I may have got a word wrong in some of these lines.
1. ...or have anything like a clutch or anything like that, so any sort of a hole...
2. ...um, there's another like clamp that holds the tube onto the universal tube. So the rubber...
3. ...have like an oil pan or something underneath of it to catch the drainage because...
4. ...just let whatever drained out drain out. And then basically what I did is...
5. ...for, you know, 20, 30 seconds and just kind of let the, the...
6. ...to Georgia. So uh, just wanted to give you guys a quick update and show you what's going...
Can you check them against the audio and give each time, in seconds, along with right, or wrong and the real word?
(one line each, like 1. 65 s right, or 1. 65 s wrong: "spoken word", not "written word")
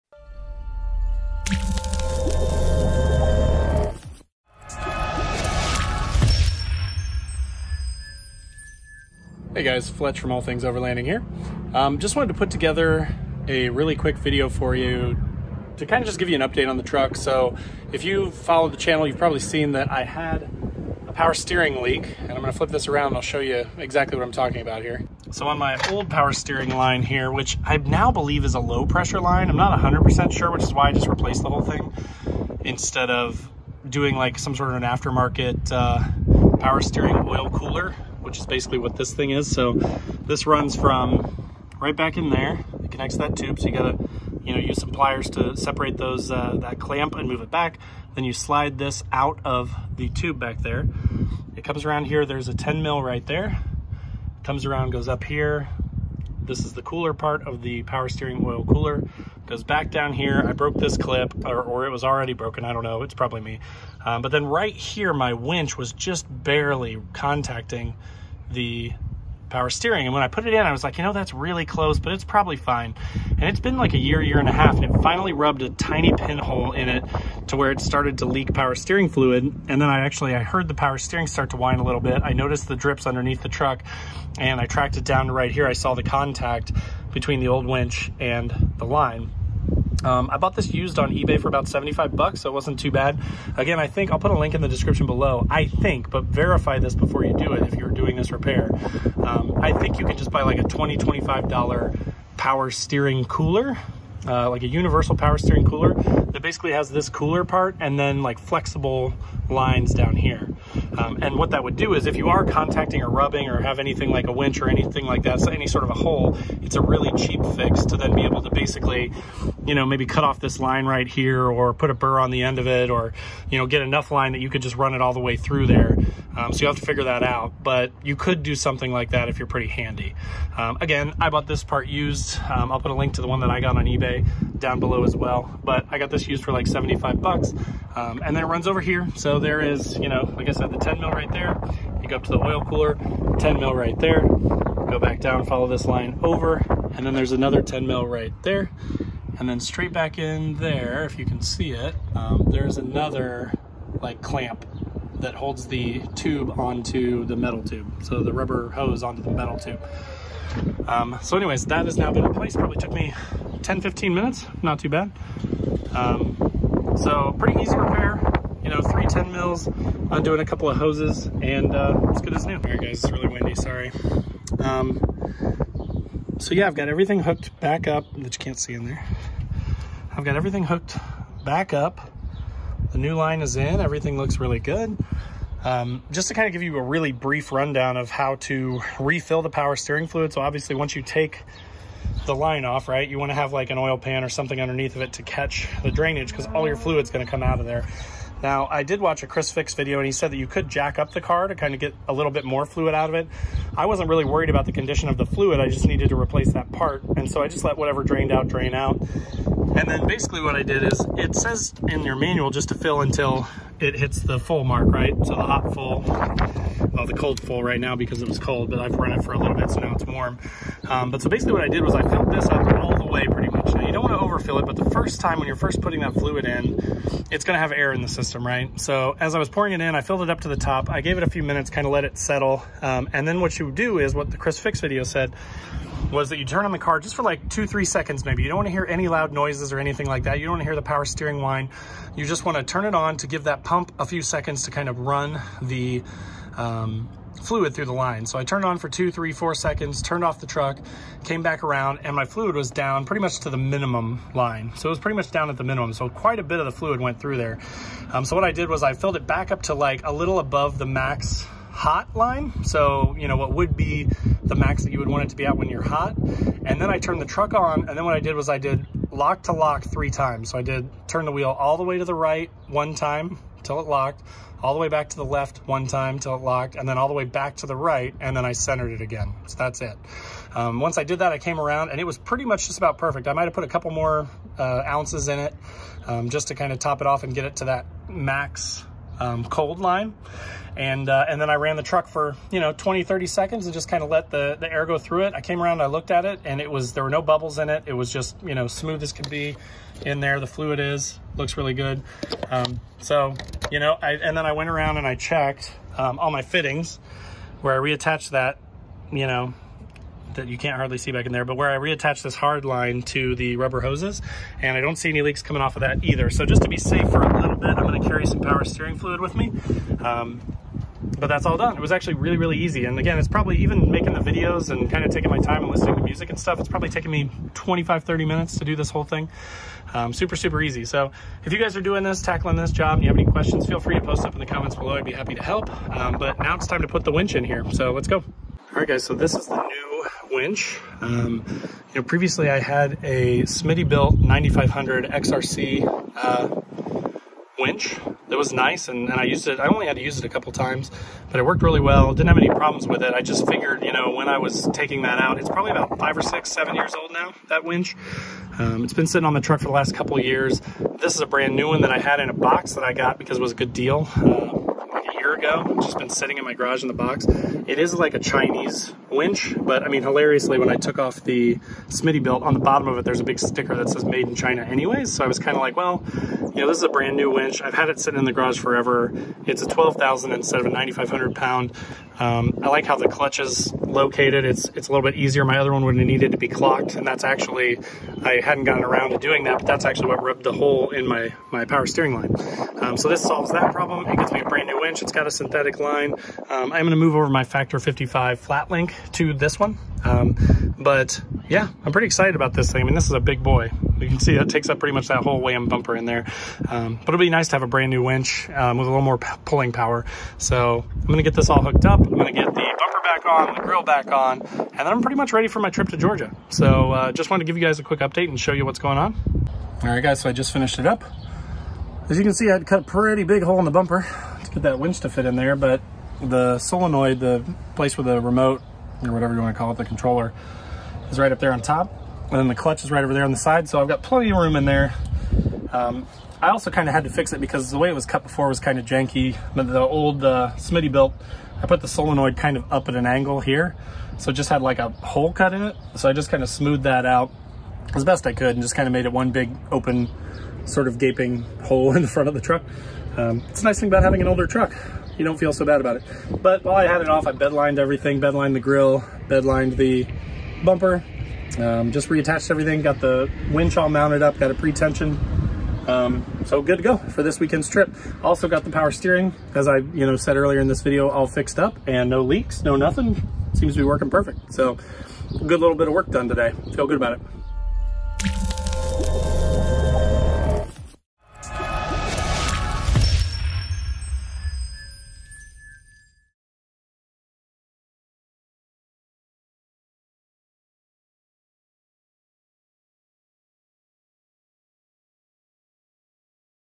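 1. 113 s wrong: "winch", not "clutch"
2. 152 s wrong: "metal", not "universal"
3. 193 s right
4. 207 s right
5. 292 s right
6. 415 s right.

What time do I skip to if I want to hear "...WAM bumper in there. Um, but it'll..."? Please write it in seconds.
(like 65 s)
405 s.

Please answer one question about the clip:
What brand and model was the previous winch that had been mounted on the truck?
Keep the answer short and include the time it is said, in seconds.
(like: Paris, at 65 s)
Smittybilt 9500 XRC, at 343 s.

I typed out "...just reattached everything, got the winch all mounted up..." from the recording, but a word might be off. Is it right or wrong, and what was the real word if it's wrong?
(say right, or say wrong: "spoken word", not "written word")
right.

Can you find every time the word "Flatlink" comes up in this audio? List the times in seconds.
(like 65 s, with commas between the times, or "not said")
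398 s.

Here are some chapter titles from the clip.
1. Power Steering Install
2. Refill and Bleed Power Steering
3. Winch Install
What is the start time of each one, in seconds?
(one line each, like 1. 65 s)
1. 25 s
2. 186 s
3. 338 s.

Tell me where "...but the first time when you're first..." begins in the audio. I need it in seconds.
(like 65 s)
224 s.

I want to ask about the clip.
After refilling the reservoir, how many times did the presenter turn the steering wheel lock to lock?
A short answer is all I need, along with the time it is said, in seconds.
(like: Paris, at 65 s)
three times, at 269 s.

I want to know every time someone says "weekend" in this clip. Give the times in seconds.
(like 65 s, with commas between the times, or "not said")
467 s.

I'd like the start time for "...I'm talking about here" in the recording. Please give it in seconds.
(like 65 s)
24 s.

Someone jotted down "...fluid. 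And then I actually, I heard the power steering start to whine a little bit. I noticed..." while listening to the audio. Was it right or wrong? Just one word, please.
right.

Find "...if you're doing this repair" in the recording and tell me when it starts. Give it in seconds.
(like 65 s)
97 s.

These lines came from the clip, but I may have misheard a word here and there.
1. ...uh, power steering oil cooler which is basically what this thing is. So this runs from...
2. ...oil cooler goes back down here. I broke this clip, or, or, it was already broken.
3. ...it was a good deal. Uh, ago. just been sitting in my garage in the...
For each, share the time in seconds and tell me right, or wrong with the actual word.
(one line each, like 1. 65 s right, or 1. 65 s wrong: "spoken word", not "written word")
1. 35 s right
2. 58 s right
3. 363 s right.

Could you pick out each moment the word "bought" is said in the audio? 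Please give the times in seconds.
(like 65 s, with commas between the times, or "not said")
90 s, 131 s.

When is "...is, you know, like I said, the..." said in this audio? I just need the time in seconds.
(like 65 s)
139 s.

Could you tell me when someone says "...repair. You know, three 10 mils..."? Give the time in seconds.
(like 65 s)
167 s.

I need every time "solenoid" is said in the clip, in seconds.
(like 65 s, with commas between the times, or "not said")
426 s, 441 s.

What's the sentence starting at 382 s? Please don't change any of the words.
Um, I like how the clutch is located.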